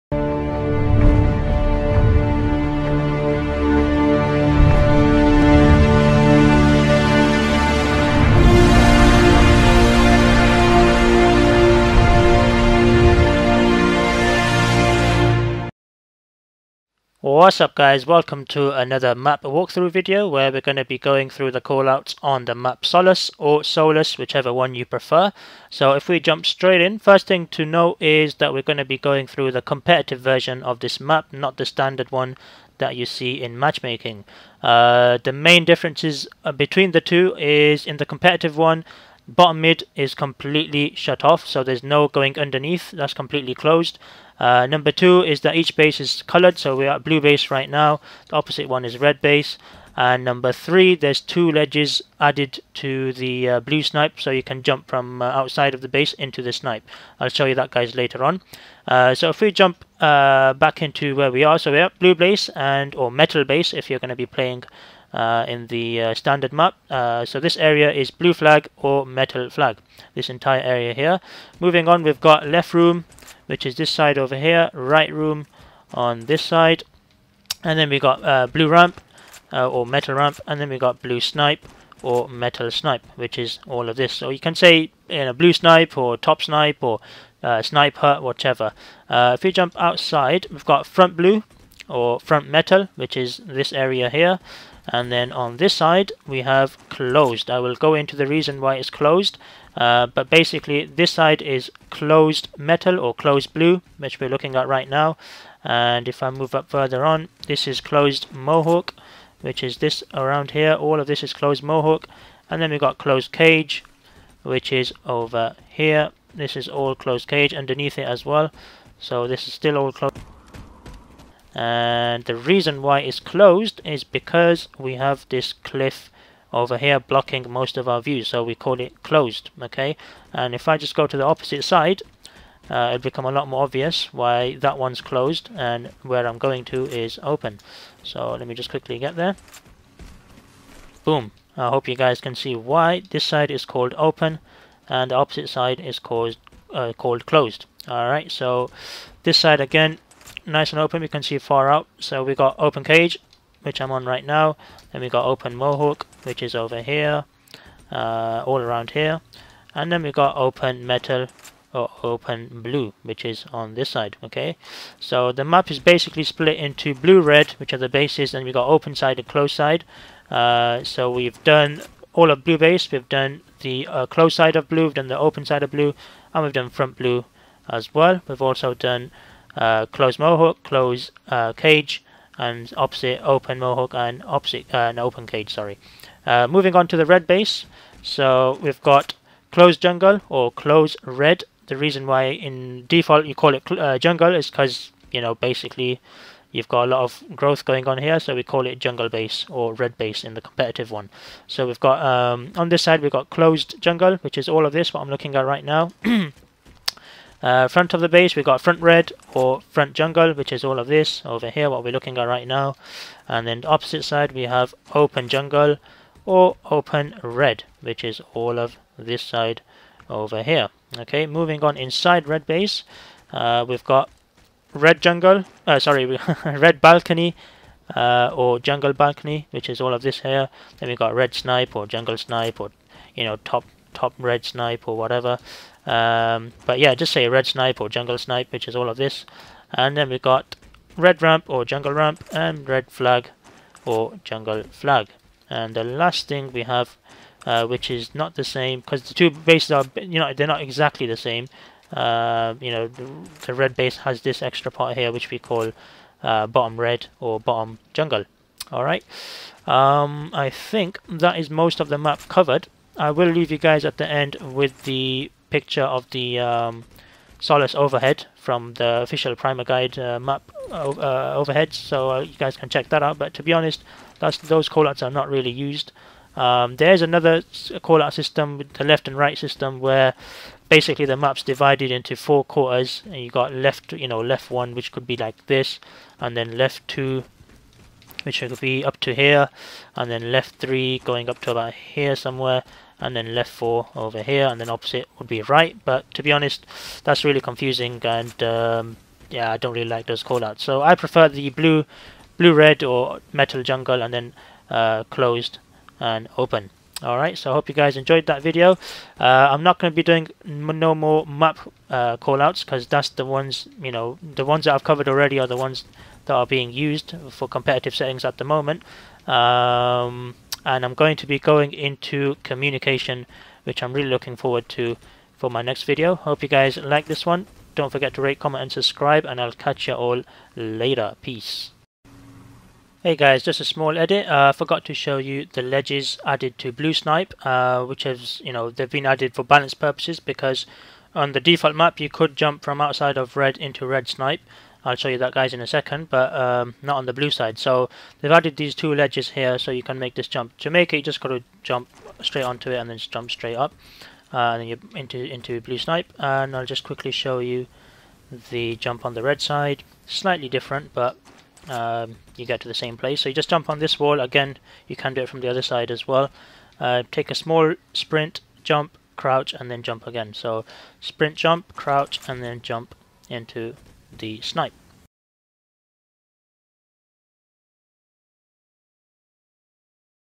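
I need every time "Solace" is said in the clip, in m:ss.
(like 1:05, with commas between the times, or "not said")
0:22, 4:27.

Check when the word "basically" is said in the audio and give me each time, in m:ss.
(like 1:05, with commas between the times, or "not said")
1:40, 2:45, 3:15, 4:40.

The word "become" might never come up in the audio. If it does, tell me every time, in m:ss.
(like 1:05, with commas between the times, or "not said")
2:13.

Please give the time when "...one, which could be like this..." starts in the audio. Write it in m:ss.
4:44.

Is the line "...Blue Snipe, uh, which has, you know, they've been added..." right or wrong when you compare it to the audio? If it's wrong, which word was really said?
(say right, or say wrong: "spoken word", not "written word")
right.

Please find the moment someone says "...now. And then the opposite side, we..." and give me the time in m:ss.
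3:32.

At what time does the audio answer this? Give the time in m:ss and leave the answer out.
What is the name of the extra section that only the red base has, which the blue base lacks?
4:16.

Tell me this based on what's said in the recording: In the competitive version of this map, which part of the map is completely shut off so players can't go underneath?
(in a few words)
Bottom mid.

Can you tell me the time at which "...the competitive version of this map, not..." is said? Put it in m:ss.
0:29.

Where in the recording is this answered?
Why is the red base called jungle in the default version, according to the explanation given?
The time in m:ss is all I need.
3:16.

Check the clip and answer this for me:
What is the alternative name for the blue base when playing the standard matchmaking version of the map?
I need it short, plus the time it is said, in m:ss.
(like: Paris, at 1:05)
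Metal base, at 1:03.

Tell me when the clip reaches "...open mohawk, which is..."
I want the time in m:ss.
2:35.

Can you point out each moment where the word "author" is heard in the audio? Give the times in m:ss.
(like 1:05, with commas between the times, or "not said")
not said.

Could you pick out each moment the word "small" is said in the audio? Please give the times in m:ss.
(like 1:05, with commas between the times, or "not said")
5:33, 6:07.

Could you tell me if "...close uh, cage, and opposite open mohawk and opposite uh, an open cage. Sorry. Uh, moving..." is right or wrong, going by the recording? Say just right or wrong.
right.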